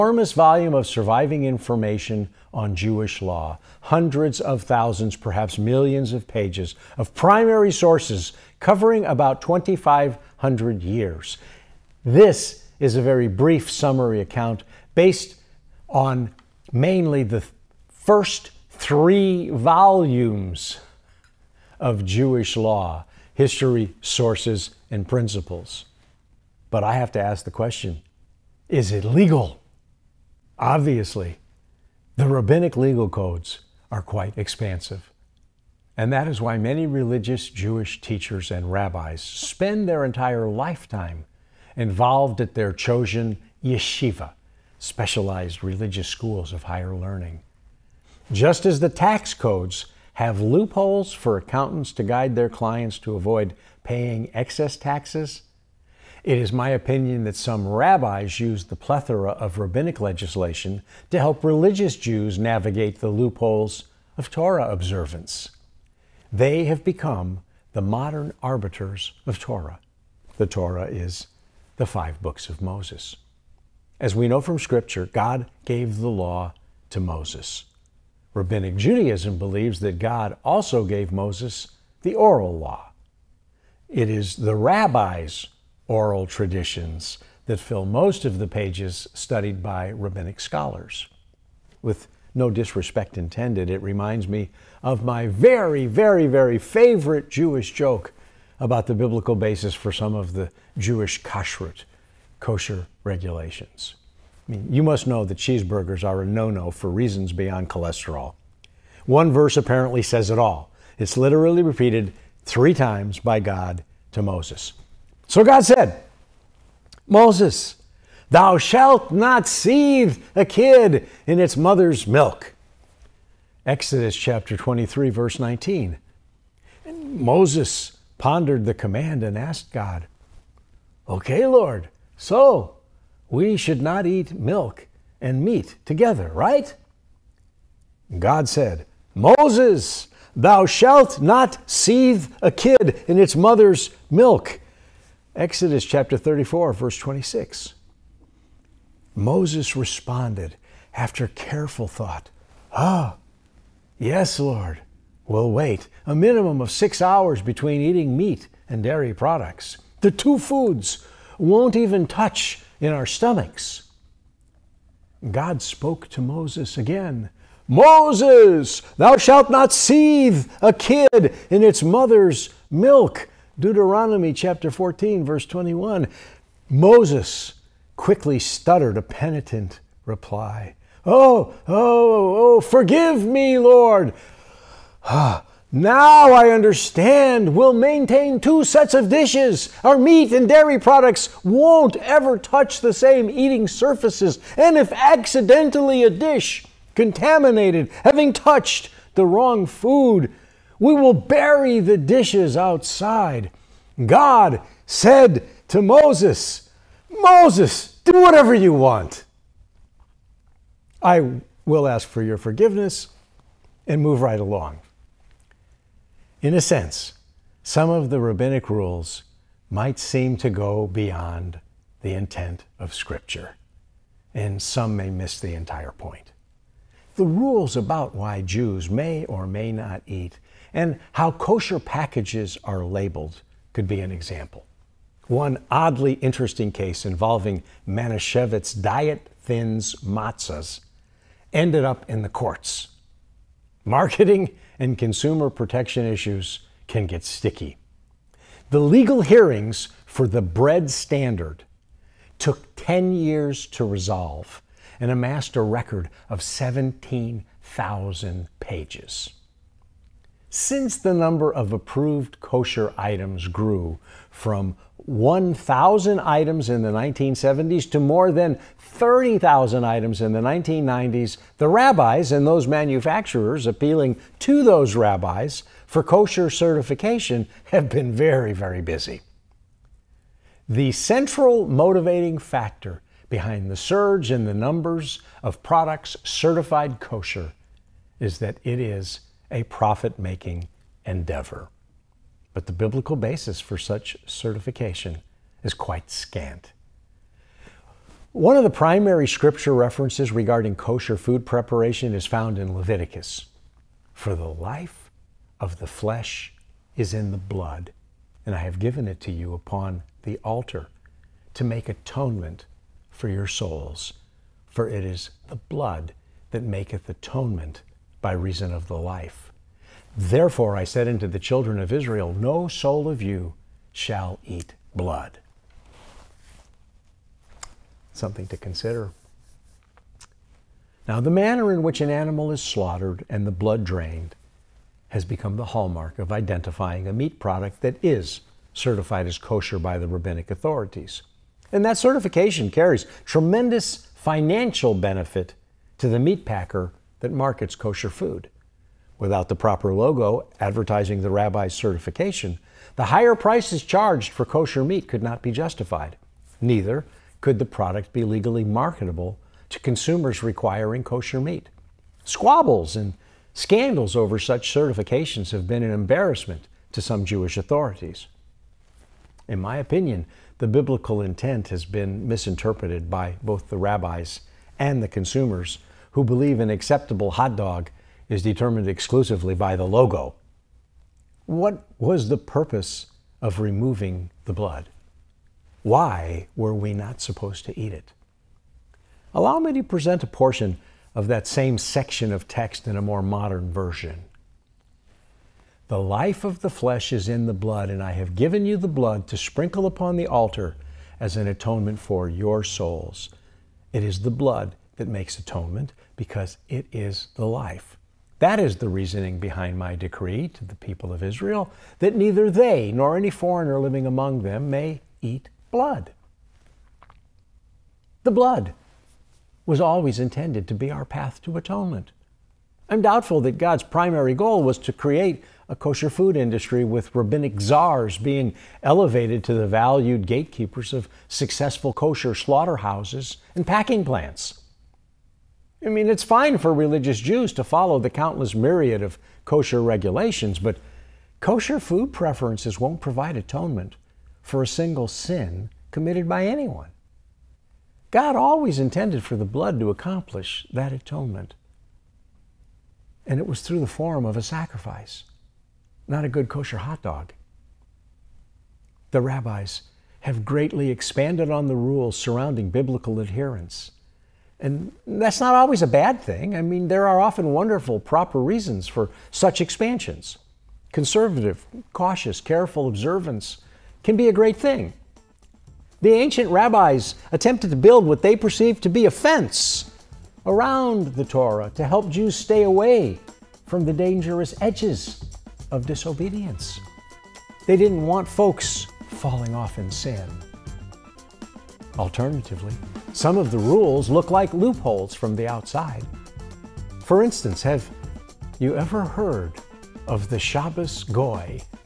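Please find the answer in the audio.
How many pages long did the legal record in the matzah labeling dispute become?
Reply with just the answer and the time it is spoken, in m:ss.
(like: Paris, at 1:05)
17,000, at 4:16.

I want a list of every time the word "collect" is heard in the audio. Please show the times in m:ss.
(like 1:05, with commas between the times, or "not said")
not said.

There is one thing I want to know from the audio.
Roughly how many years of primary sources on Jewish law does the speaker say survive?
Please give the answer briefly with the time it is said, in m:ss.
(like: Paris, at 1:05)
2,500 years, at 0:09.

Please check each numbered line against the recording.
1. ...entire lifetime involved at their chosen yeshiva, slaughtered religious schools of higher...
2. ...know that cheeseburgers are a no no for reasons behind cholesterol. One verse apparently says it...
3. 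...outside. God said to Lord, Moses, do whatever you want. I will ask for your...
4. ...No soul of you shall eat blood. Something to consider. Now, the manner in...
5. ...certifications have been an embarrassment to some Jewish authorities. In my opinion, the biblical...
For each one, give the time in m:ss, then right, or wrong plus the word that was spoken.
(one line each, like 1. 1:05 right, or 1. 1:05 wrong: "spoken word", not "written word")
1. 0:40 wrong: "specialized", not "slaughtered"
2. 1:45 wrong: "beyond", not "behind"
3. 3:22 wrong: "Moses", not "Lord"
4. 5:22 right
5. 6:04 right.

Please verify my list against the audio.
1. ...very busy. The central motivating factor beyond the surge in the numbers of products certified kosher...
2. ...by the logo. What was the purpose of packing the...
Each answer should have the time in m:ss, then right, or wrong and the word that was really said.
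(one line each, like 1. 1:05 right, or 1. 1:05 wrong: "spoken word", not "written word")
1. 4:38 wrong: "behind", not "beyond"
2. 6:19 wrong: "removing", not "packing".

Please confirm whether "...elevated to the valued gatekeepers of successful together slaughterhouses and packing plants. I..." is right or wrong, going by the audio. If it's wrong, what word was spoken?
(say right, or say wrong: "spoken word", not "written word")
wrong: "kosher", not "together".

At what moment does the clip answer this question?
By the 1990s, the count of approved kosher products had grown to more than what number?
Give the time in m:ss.
4:28.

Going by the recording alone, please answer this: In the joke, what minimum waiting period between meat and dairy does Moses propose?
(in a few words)
6 hours.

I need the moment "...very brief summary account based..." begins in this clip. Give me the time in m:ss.
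0:13.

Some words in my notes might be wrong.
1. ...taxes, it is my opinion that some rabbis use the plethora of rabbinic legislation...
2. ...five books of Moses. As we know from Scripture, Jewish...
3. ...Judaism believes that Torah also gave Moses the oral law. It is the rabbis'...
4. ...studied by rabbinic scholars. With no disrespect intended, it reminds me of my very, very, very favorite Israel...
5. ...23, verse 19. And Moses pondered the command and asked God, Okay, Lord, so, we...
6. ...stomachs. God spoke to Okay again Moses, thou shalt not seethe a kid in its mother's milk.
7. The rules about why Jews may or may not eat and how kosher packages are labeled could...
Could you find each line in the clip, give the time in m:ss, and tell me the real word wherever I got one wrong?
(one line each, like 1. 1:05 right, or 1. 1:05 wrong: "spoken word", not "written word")
1. 0:54 right
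2. 1:11 wrong: "God", not "Jewish"
3. 1:18 wrong: "God", not "Torah"
4. 1:29 wrong: "Jewish", not "Israel"
5. 2:04 right
6. 2:43 wrong: "Moses", not "Okay"
7. 3:47 right.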